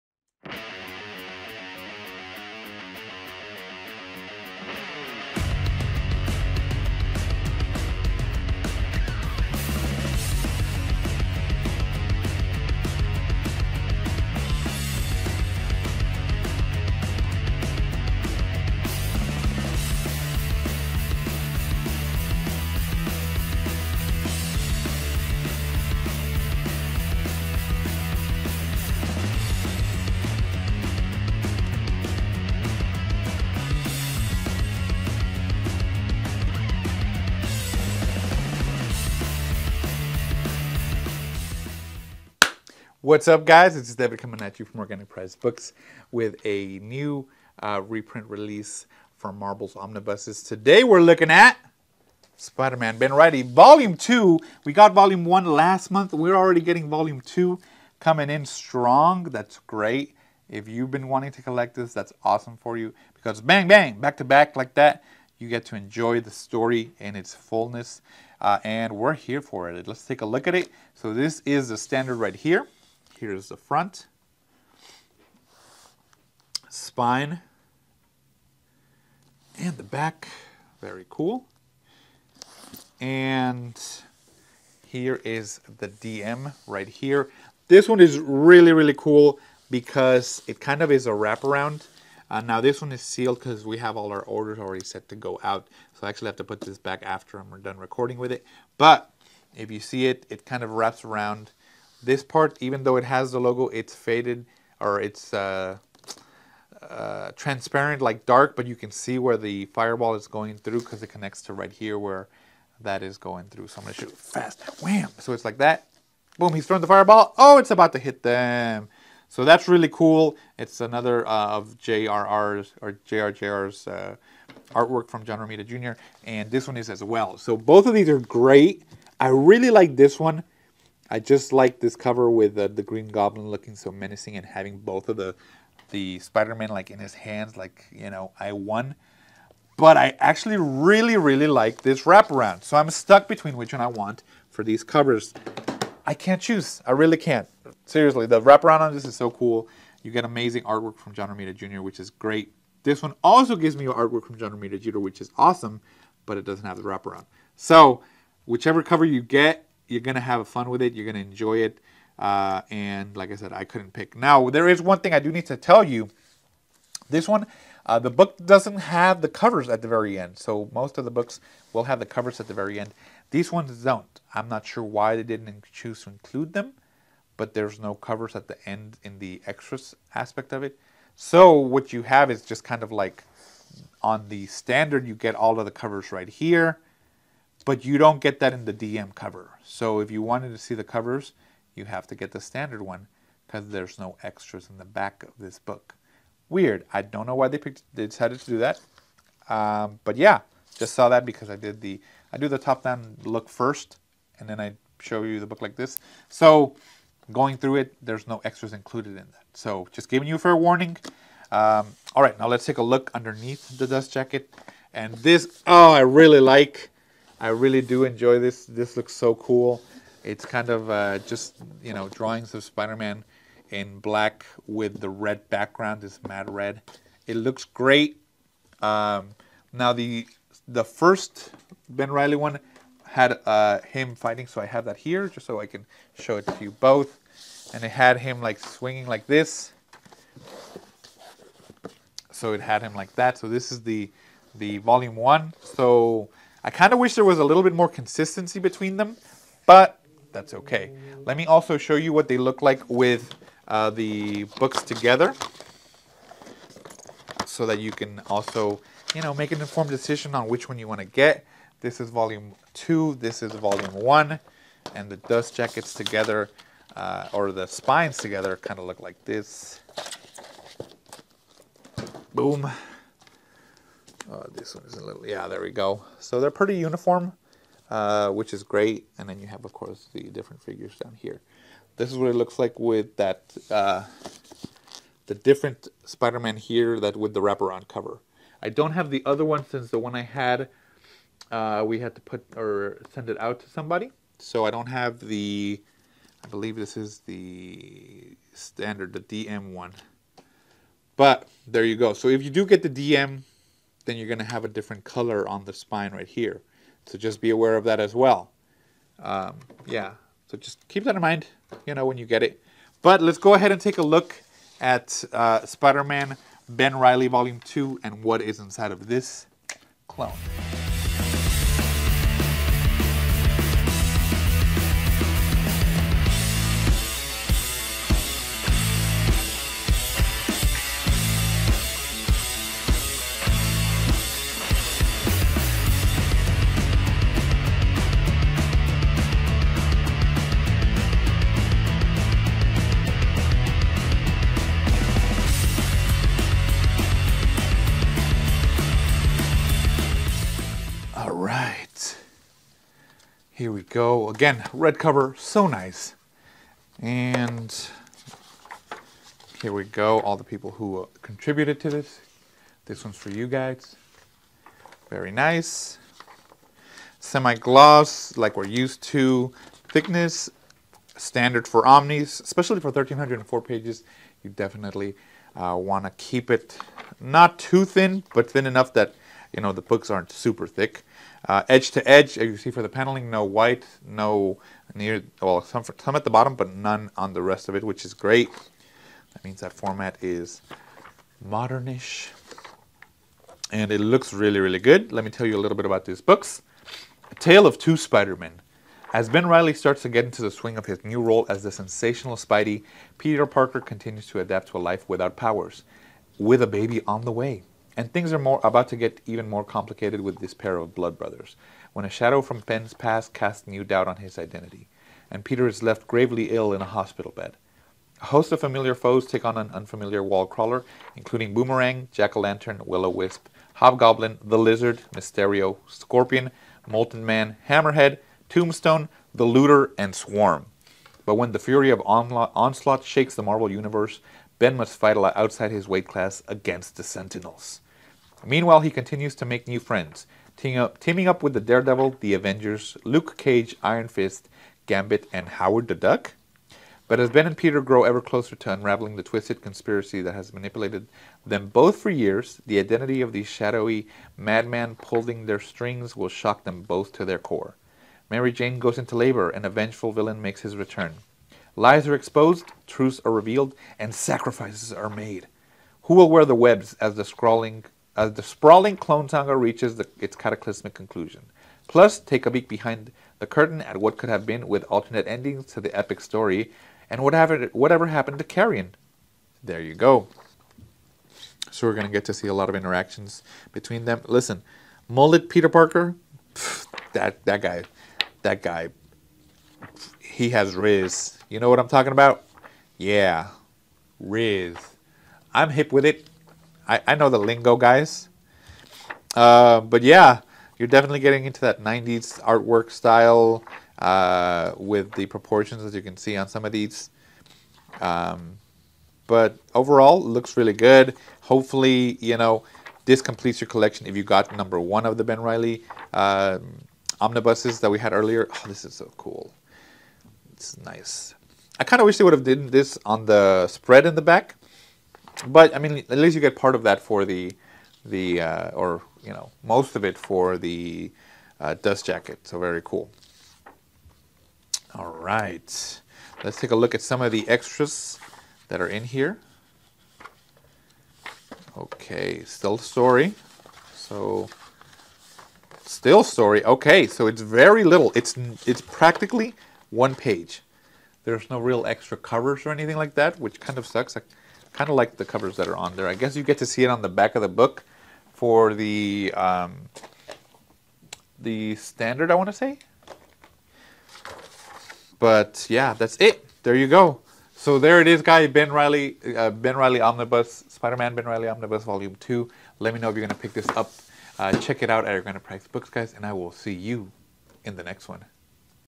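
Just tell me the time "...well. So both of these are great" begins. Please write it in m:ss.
2:07.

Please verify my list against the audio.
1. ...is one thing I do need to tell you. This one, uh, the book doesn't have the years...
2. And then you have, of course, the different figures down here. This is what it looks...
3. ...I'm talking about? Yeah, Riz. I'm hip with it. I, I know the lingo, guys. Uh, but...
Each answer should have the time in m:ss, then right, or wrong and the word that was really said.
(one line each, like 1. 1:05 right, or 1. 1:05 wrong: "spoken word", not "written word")
1. 2:44 wrong: "covers", not "years"
2. 4:39 right
3. 8:11 right.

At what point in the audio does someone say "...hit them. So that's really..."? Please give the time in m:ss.
1:57.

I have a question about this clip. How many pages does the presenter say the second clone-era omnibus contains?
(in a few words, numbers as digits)
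1304.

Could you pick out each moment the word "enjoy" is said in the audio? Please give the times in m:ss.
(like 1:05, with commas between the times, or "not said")
1:05, 2:41, 3:38.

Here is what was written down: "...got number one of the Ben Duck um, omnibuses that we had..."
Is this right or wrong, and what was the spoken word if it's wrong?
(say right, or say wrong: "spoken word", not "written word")
wrong: "Reilly", not "Duck".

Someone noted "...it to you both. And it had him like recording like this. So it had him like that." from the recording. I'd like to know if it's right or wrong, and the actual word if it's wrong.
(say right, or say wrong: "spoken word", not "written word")
wrong: "swinging", not "recording".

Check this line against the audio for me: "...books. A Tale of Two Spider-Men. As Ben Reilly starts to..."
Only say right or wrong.
right.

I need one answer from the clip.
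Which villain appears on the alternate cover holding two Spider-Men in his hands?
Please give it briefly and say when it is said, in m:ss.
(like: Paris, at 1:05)
Green Goblin, at 2:12.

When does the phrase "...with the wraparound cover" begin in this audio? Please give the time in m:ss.
4:47.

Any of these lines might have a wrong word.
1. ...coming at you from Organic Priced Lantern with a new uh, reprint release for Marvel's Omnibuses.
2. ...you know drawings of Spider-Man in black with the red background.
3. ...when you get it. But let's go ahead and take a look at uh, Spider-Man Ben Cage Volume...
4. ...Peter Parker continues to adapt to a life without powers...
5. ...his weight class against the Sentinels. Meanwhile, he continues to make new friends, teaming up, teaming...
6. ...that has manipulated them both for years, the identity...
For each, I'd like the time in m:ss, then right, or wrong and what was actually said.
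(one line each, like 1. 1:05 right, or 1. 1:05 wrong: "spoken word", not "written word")
1. 0:44 wrong: "Books", not "Lantern"
2. 3:41 right
3. 5:12 wrong: "Reilly", not "Cage"
4. 6:43 right
5. 7:15 right
6. 7:30 right.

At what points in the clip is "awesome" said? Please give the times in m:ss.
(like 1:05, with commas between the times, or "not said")
1:02, 2:35.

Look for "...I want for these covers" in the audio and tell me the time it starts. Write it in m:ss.
2:23.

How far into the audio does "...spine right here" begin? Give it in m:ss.
5:05.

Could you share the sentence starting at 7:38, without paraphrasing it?
Mary Jane goes into labor, and a vengeful villain makes his return.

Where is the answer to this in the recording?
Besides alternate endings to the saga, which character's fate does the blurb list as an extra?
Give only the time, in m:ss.
7:58.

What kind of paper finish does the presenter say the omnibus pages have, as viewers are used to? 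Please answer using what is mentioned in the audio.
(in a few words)
Semi-gloss.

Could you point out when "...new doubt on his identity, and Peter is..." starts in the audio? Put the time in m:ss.
6:53.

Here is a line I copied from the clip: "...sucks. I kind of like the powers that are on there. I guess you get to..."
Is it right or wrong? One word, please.
wrong.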